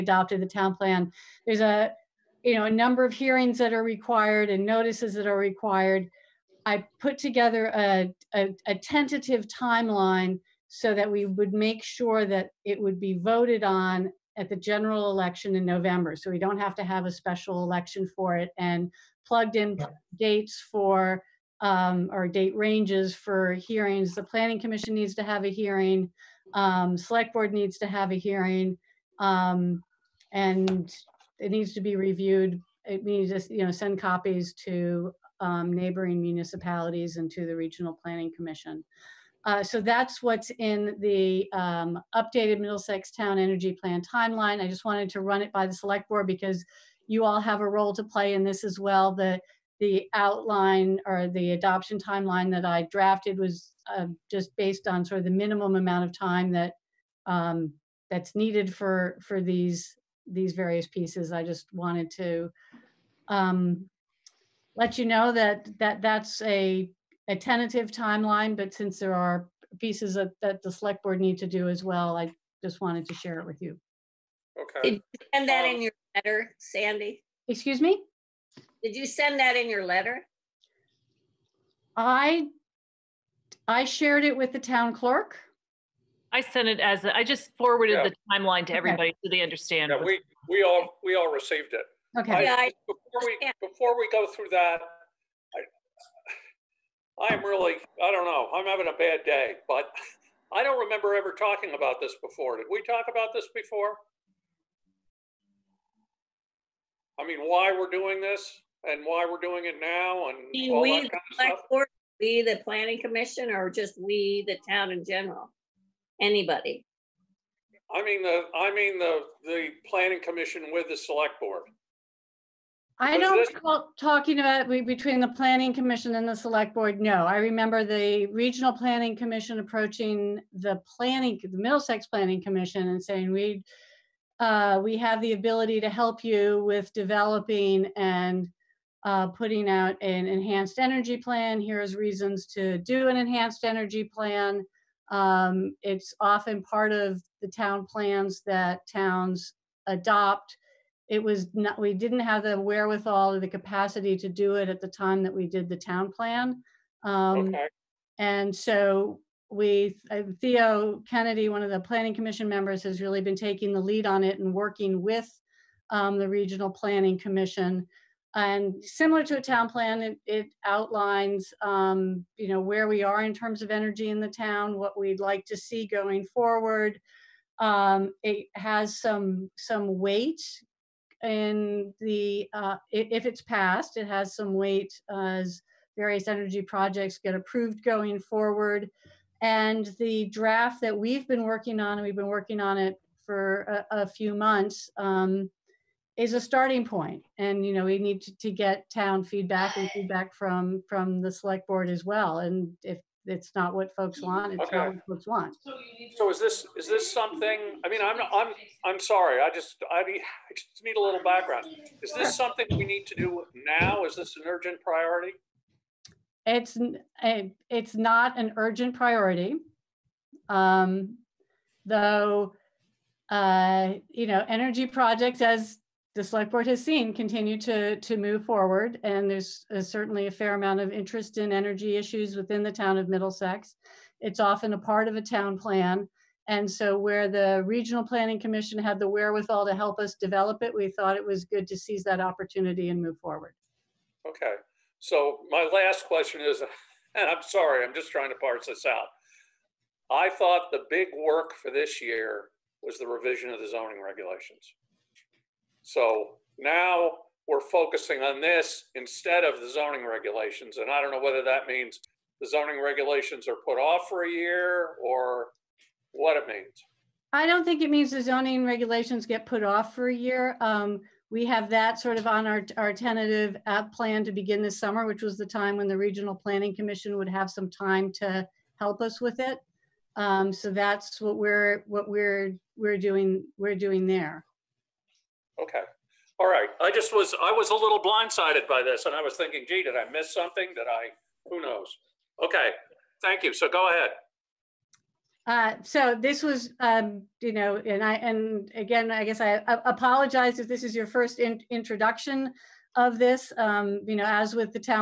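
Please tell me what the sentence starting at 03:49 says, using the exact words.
And there's a, uh, certainly a fair amount of interest in energy issues within the town of Middlesex.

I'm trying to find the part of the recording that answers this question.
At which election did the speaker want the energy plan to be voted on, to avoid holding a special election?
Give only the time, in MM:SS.
00:14.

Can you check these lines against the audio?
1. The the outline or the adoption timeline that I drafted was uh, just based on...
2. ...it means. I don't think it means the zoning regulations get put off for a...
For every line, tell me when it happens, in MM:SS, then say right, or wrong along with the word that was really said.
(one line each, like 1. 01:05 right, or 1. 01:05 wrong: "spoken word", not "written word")
1. 00:49 right
2. 04:26 right.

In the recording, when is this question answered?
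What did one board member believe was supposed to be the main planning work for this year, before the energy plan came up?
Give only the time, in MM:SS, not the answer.
04:13.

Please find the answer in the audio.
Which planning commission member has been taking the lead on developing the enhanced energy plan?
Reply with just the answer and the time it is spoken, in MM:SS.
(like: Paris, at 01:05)
Theo Kennedy, at 02:40.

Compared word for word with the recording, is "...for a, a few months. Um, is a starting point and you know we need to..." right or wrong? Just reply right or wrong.
right.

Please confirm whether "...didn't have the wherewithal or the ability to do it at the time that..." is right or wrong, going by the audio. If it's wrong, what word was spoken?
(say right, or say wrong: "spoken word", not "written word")
wrong: "capacity", not "ability".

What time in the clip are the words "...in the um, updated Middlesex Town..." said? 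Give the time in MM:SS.
00:40.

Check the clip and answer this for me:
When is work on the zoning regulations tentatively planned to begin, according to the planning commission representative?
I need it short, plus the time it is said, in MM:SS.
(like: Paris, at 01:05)
This summer, at 04:34.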